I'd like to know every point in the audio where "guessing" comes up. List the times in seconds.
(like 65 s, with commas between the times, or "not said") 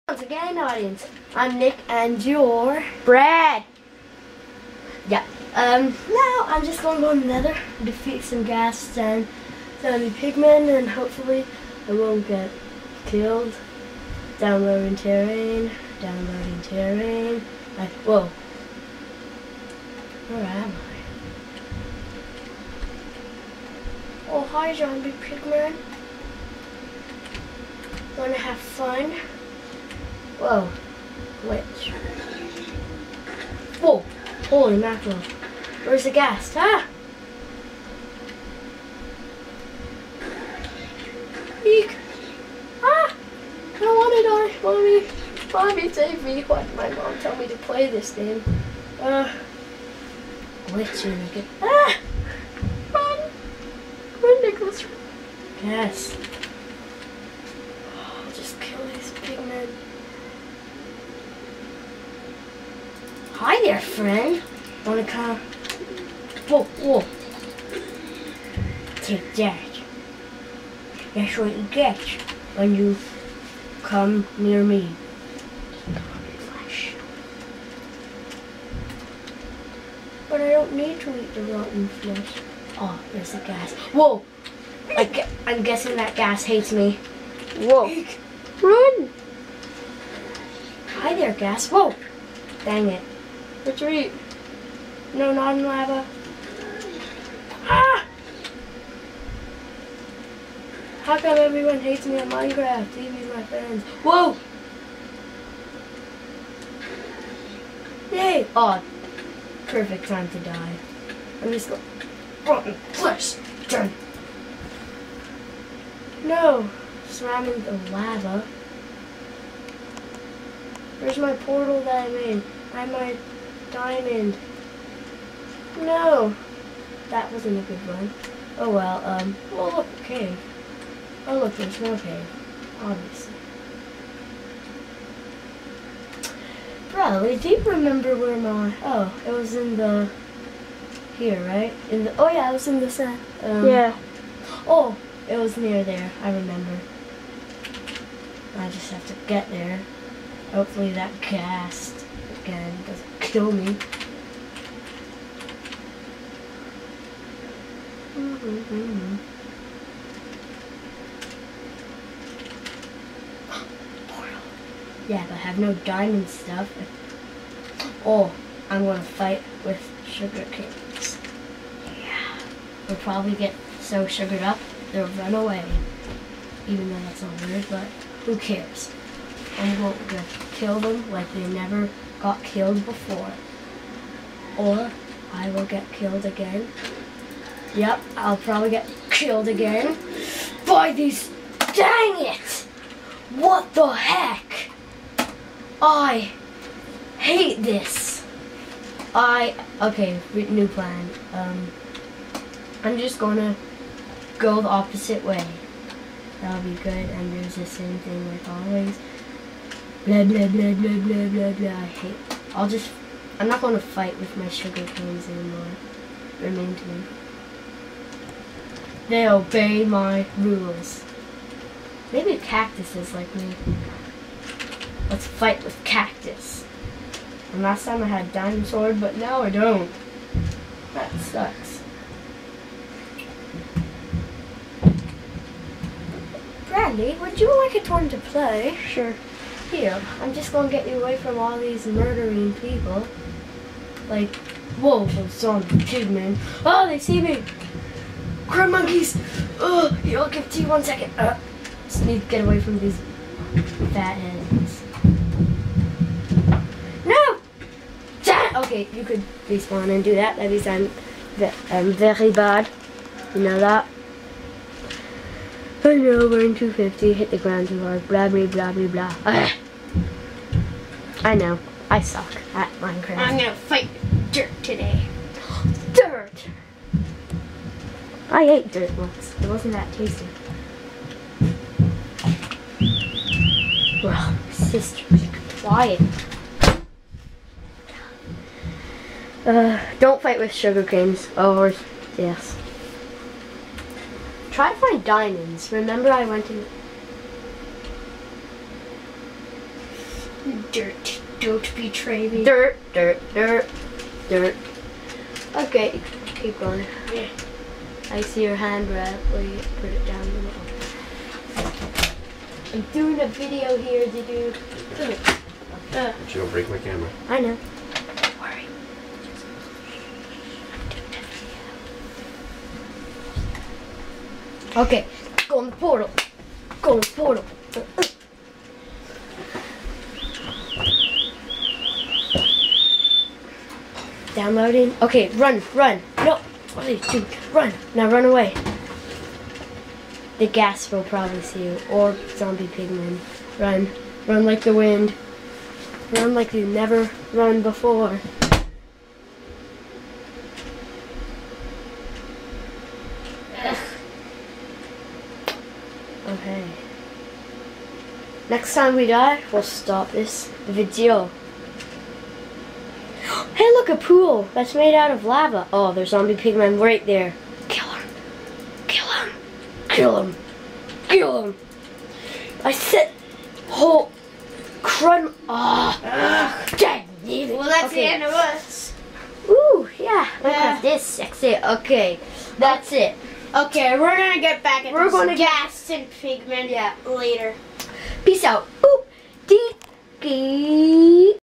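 85 s.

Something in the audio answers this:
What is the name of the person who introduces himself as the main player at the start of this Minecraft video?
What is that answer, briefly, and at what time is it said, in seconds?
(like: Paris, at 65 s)
Nick, at 1 s.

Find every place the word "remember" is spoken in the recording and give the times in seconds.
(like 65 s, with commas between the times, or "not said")
137 s, 146 s, 295 s.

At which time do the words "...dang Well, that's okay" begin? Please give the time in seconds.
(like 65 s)
376 s.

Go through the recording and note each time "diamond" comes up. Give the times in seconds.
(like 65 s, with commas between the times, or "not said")
123 s, 165 s, 295 s.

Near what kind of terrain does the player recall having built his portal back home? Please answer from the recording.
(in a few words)
Sand.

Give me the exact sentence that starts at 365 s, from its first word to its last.
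Oh, there's zombie pigmen right there.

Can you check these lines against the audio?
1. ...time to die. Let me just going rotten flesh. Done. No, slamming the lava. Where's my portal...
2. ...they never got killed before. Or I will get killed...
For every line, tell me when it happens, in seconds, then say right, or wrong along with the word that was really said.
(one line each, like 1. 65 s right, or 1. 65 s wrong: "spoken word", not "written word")
1. 110 s right
2. 181 s right.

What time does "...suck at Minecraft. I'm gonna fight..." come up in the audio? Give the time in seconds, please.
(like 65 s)
271 s.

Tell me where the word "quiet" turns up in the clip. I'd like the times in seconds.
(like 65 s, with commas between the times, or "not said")
285 s.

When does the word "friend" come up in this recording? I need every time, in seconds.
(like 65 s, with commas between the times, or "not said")
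63 s, 103 s.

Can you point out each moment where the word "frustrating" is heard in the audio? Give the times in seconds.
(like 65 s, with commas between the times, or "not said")
not said.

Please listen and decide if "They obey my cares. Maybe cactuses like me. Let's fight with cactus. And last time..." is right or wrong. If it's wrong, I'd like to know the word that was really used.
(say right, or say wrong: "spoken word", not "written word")
wrong: "rules", not "cares".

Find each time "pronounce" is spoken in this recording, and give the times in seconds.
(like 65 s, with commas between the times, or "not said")
not said.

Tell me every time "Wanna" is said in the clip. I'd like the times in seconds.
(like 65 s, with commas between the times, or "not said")
28 s, 64 s.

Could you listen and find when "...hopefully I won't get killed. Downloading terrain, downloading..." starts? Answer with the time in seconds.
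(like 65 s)
10 s.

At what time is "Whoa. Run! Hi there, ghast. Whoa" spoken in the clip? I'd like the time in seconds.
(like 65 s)
87 s.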